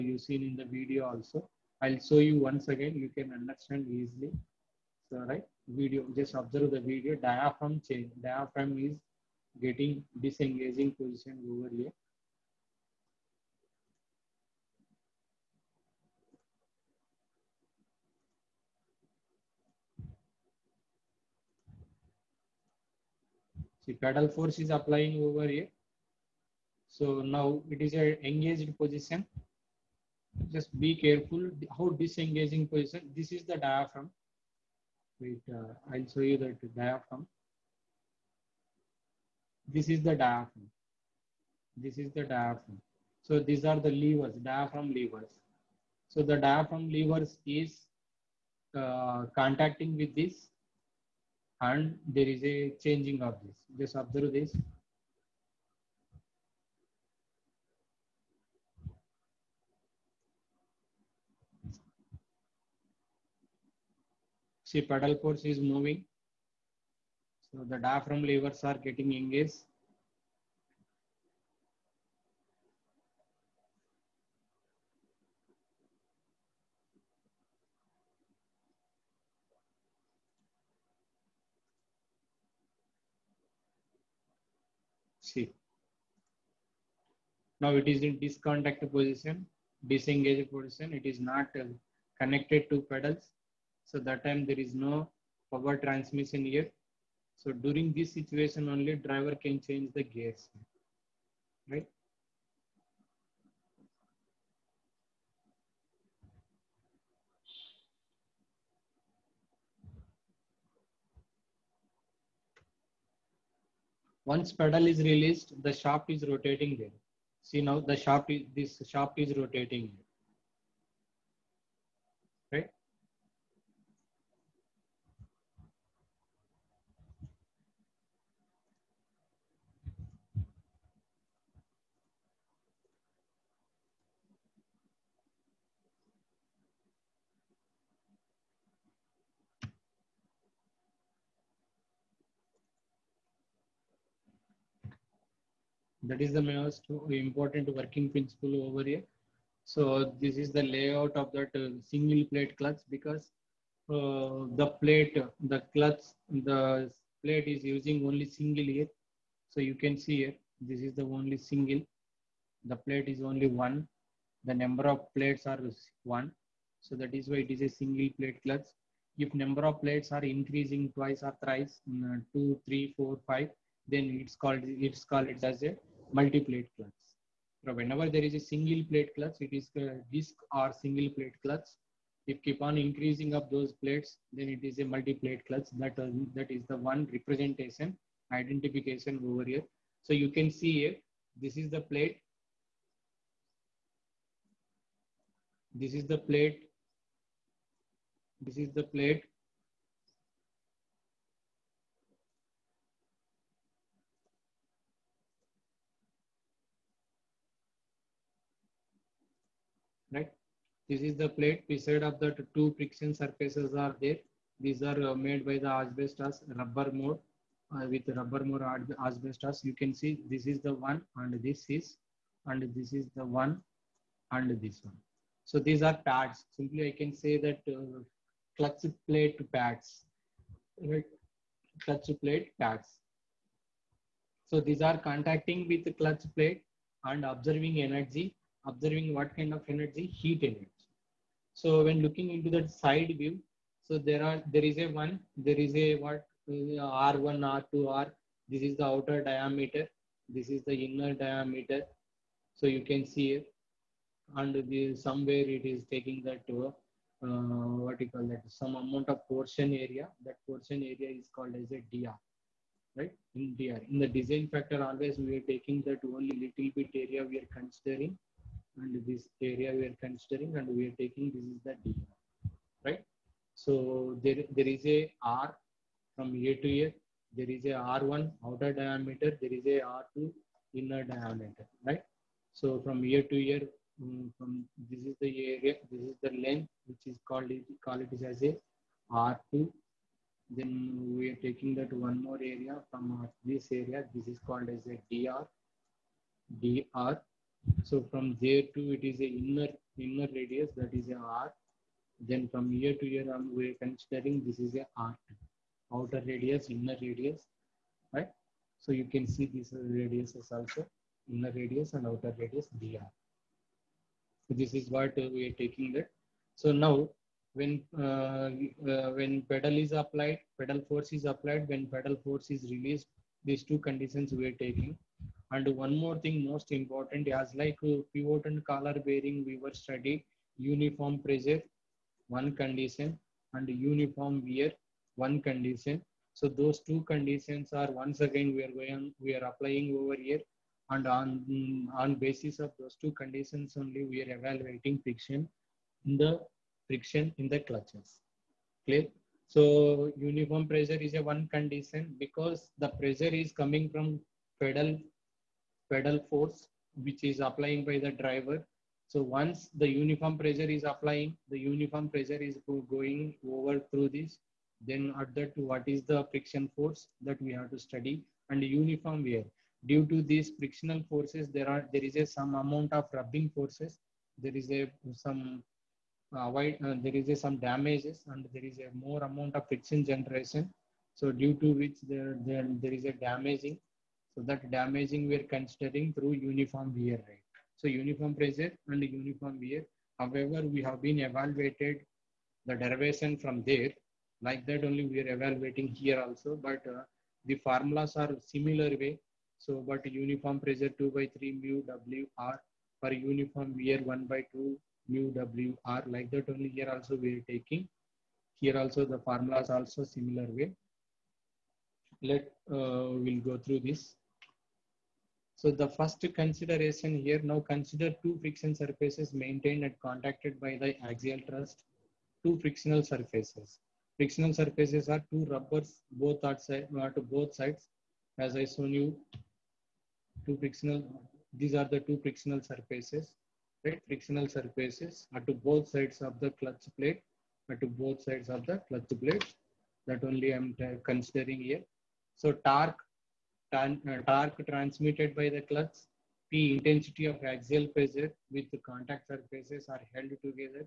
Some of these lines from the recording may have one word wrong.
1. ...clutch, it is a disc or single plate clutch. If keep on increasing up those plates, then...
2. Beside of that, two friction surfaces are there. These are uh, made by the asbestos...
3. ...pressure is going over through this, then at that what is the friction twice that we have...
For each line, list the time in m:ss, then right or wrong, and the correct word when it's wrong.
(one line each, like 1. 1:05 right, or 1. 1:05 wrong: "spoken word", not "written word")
1. 2:59 right
2. 3:31 right
3. 6:02 wrong: "force", not "twice".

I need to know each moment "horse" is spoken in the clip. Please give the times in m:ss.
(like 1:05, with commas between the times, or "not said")
not said.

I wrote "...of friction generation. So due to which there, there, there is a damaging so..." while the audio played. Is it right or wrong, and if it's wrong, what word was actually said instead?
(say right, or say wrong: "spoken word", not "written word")
right.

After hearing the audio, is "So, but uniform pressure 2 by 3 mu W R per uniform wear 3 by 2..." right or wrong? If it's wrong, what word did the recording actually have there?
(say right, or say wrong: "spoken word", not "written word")
wrong: "1", not "3".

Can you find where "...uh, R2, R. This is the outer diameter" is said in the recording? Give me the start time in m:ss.
4:07.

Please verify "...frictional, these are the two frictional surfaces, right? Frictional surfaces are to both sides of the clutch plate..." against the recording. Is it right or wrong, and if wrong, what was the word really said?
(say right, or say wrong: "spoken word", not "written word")
right.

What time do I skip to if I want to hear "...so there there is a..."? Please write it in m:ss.
4:33.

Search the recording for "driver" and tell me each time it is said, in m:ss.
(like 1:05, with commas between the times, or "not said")
1:38, 5:58.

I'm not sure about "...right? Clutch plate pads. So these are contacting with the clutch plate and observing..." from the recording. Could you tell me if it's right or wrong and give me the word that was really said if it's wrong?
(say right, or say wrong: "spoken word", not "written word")
right.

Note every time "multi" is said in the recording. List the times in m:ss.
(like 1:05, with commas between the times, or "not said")
2:56, 3:04.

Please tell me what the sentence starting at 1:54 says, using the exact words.
Once pedal is released, the shaft is rotating there.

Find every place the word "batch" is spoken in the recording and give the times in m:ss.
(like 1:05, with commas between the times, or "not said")
not said.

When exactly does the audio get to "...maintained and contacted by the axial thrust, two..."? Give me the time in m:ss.
6:59.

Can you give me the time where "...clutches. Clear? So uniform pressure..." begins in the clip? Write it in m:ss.
5:47.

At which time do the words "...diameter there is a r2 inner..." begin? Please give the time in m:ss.
4:38.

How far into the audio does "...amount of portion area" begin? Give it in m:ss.
4:18.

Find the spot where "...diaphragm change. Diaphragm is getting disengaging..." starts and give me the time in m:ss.
0:07.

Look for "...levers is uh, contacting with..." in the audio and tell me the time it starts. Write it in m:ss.
0:46.